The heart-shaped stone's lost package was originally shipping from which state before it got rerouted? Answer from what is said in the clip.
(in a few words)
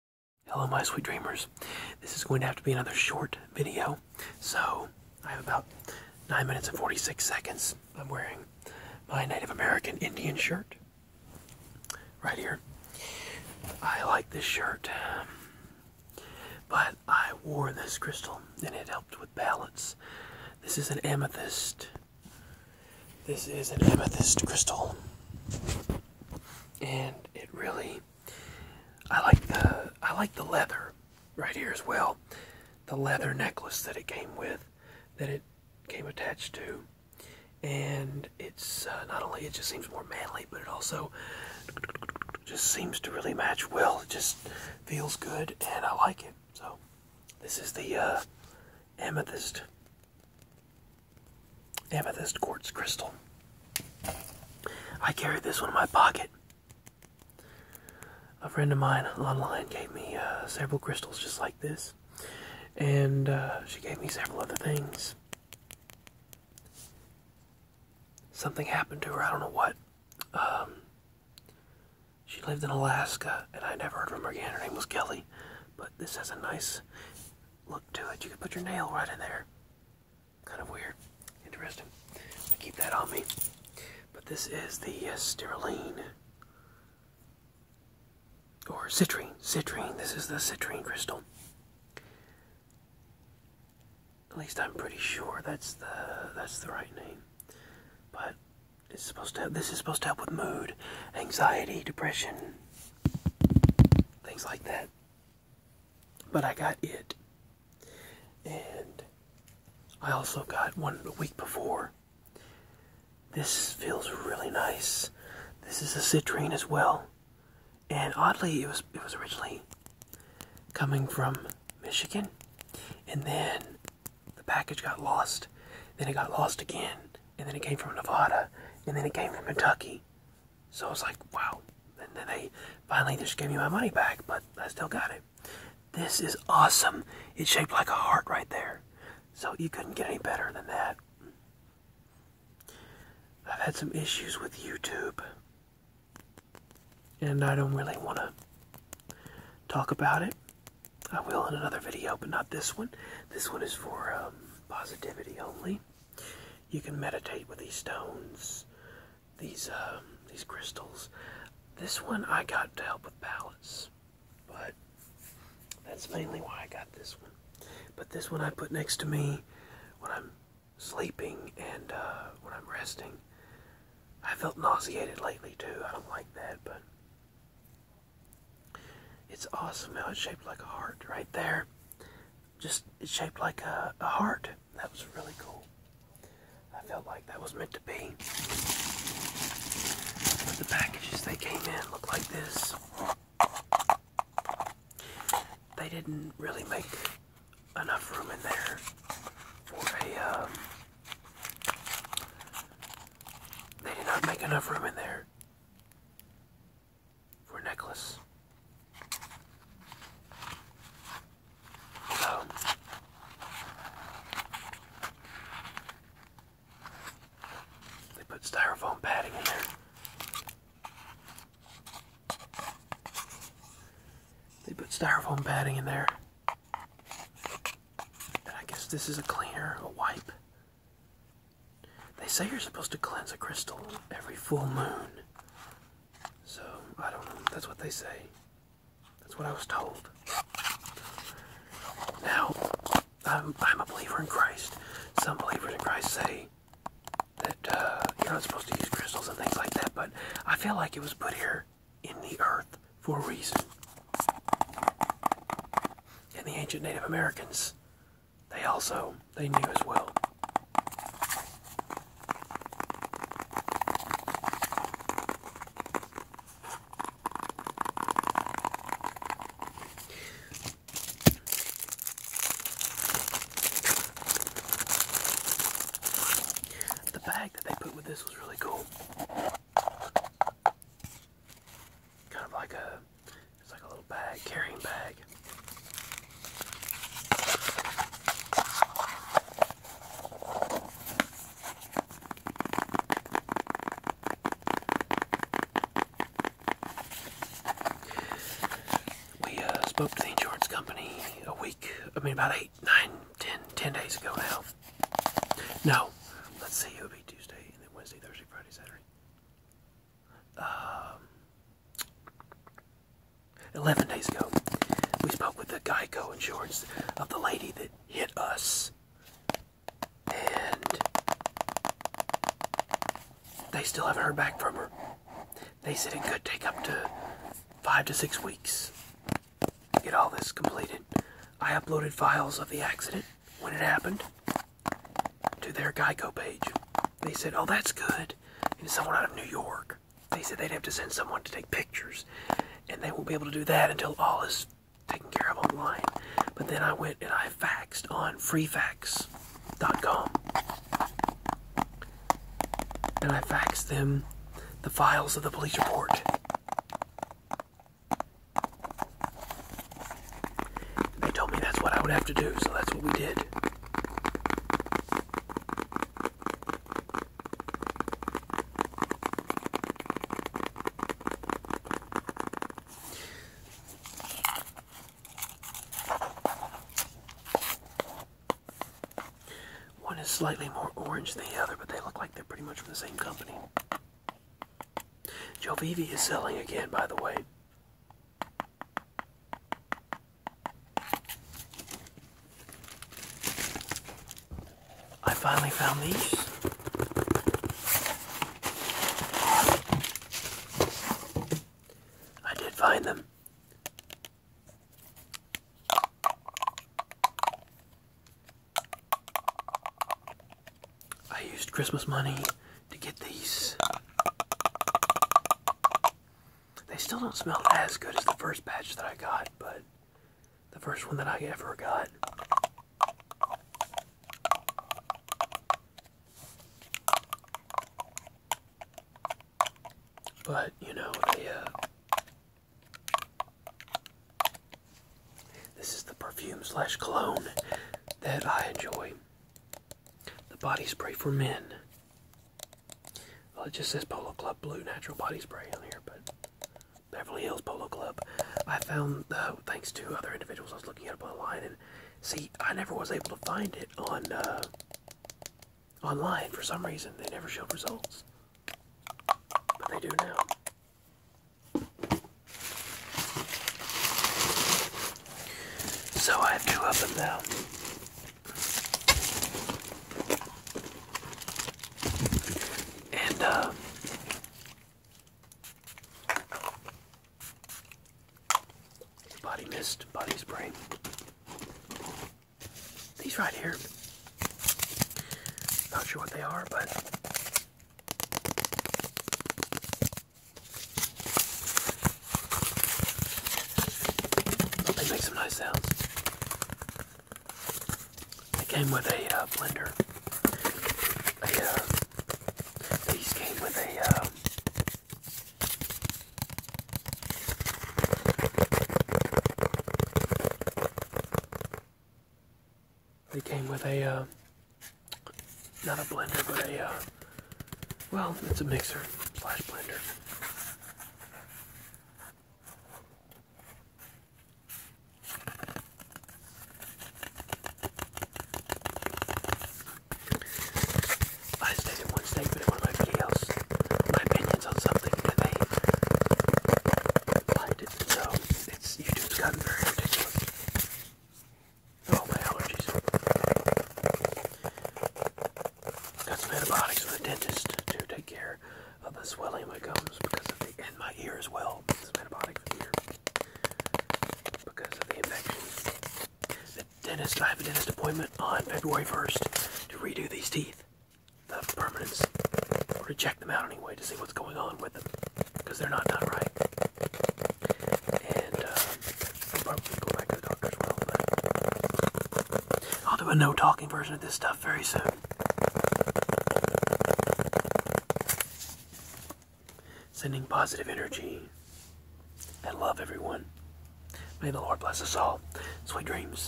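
Michigan.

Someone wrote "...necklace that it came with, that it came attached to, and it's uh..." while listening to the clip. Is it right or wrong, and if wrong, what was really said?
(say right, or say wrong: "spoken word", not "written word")
right.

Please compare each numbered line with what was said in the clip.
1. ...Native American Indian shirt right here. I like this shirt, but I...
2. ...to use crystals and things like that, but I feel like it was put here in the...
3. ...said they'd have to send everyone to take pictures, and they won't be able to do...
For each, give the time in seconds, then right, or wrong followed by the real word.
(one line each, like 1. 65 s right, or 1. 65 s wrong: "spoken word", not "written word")
1. 9 s right
2. 248 s right
3. 340 s wrong: "someone", not "everyone".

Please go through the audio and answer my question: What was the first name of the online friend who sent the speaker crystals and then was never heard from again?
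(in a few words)
Kelly.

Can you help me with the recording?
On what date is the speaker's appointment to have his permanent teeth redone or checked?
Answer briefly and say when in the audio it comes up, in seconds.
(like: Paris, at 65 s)
February 1, at 558 s.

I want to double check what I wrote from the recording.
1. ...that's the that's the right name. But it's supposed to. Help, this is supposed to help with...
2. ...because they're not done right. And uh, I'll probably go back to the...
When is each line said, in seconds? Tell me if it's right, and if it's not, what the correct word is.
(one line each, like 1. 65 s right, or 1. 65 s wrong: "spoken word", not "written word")
1. 95 s right
2. 565 s right.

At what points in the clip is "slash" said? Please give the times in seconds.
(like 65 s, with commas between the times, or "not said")
436 s, 519 s.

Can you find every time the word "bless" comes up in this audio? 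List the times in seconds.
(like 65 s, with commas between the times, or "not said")
584 s.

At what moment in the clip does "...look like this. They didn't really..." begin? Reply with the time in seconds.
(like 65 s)
191 s.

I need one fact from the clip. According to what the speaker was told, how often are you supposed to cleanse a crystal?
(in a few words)
Every full moon.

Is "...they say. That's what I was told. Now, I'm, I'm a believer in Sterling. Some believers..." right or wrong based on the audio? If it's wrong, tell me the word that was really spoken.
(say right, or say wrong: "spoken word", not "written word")
wrong: "Christ", not "Sterling".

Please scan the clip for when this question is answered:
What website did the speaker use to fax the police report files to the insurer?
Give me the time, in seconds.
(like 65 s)
348 s.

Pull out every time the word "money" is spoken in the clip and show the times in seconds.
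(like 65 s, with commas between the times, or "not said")
133 s, 412 s.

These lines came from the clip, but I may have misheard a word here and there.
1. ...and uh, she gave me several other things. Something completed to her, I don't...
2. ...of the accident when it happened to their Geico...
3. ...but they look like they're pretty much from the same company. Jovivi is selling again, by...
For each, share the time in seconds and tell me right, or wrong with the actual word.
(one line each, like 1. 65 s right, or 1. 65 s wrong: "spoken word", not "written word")
1. 62 s wrong: "happened", not "completed"
2. 332 s right
3. 381 s right.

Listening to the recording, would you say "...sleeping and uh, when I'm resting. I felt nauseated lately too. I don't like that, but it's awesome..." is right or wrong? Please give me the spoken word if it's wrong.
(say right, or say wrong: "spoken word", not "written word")
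right.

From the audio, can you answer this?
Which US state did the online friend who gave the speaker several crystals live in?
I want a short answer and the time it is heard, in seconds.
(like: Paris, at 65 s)
Alaska, at 72 s.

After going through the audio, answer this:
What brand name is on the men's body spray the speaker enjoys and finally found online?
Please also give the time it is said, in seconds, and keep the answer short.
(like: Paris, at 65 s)
Beverly Hills Polo Club, at 447 s.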